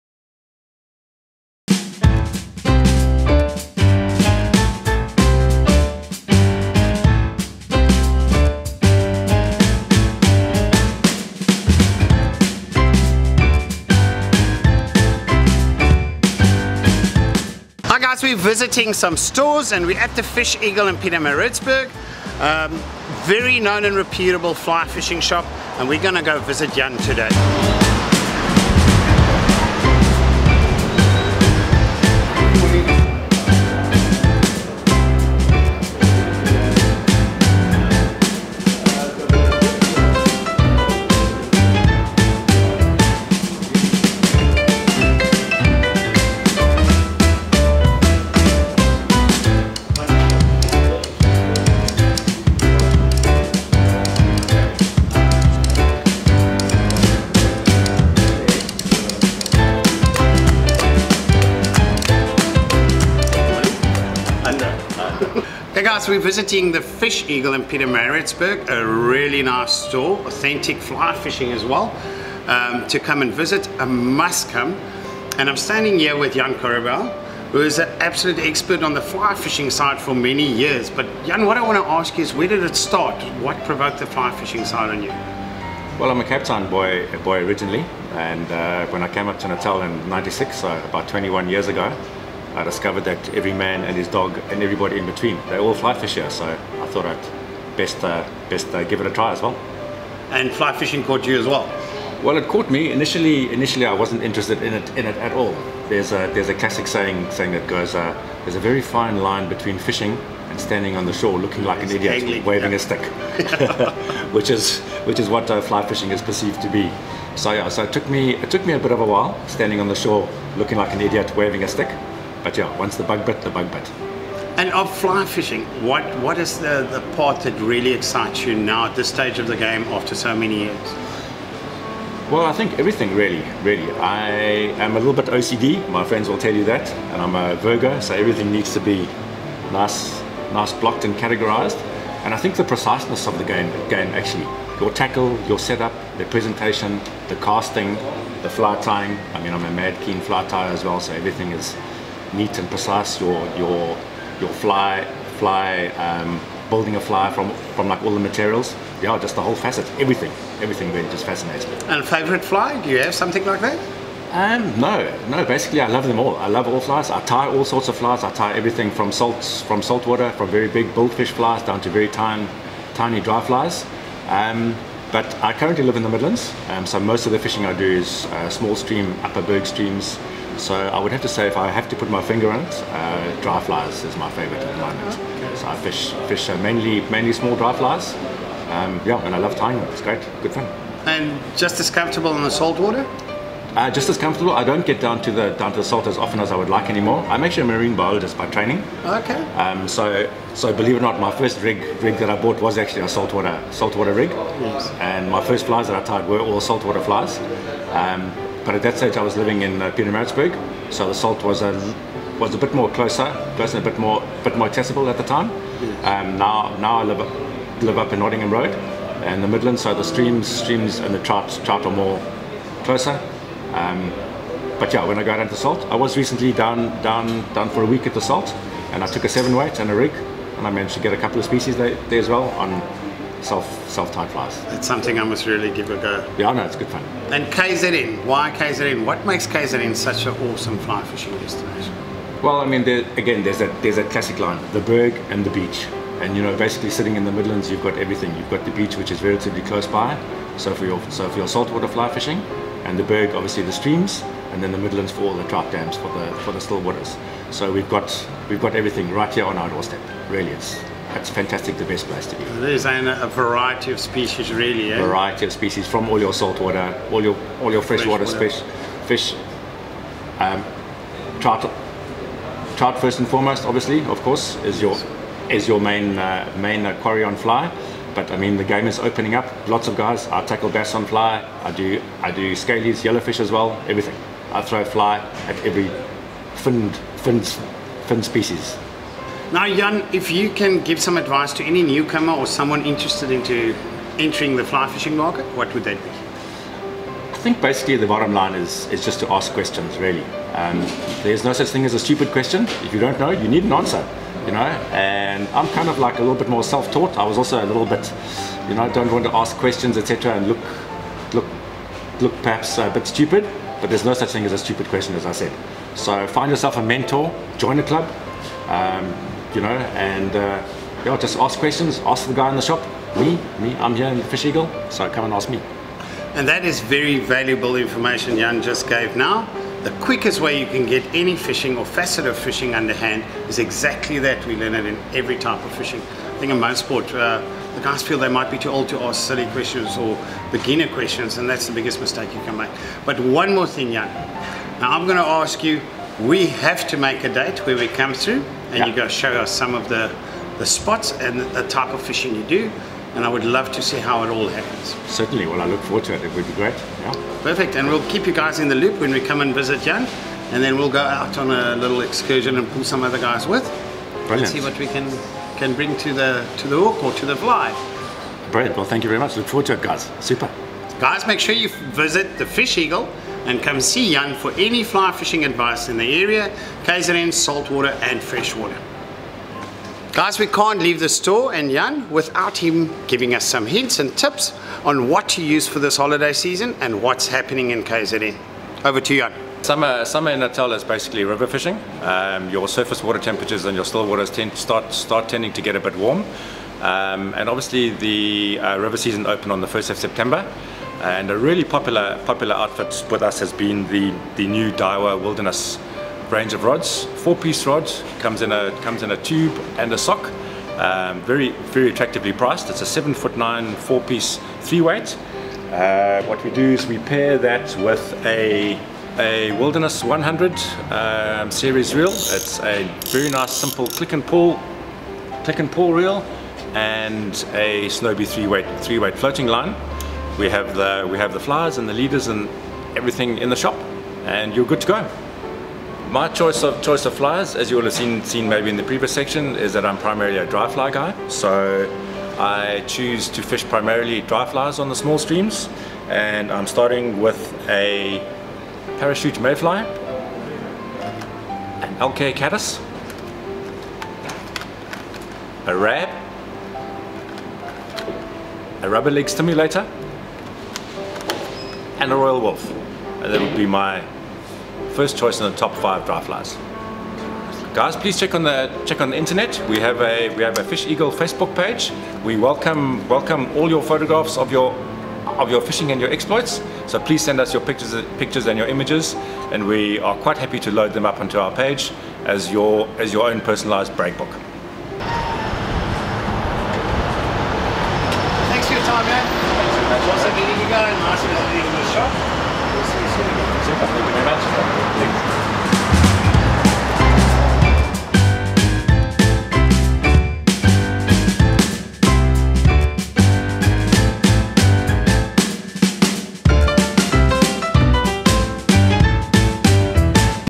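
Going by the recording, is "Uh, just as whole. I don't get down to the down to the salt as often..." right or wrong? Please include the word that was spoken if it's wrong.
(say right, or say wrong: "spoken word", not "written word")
wrong: "comfortable", not "whole".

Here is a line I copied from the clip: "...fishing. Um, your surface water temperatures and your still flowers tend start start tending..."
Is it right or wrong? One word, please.
wrong.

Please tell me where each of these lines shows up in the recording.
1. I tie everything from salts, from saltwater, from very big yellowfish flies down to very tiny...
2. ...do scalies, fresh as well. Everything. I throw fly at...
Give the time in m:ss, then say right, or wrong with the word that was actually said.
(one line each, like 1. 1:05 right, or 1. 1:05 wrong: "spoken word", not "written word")
1. 2:48 wrong: "bullfish", not "yellowfish"
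2. 4:42 wrong: "yellowfish", not "fresh".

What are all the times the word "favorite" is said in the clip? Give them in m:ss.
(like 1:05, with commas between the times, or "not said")
2:42, 3:04.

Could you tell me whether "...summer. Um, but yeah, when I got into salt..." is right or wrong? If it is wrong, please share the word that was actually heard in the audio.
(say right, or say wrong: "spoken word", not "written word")
wrong: "closer", not "summer".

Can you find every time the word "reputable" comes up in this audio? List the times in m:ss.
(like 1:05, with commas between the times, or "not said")
0:23.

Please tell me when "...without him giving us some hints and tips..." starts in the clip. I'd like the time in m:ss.
6:22.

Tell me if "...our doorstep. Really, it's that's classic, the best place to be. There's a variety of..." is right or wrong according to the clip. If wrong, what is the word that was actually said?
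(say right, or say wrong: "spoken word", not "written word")
wrong: "fantastic", not "classic".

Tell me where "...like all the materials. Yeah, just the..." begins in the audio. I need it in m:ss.
2:37.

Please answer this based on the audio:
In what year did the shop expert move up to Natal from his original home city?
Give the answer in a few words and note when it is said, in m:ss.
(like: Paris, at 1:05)
1996, at 1:30.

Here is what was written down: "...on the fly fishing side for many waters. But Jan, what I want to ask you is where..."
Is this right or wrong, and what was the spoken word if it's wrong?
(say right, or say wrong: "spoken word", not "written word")
wrong: "years", not "waters".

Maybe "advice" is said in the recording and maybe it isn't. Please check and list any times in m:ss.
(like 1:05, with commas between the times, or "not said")
4:51, 6:15.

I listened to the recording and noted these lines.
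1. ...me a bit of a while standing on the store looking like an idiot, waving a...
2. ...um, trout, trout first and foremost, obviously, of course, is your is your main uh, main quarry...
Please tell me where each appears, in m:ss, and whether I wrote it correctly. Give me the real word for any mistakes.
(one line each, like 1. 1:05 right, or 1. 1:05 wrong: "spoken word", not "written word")
1. 1:58 wrong: "shore", not "store"
2. 4:30 right.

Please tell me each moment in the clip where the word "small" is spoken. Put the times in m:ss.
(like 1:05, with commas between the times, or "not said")
2:58, 3:07, 7:24.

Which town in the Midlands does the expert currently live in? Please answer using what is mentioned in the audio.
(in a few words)
Nottingham Road.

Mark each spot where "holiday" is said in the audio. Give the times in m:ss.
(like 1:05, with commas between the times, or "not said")
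6:25.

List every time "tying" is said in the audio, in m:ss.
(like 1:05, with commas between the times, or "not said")
2:28, 3:09.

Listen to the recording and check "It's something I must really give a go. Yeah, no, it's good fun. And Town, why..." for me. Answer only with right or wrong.
wrong.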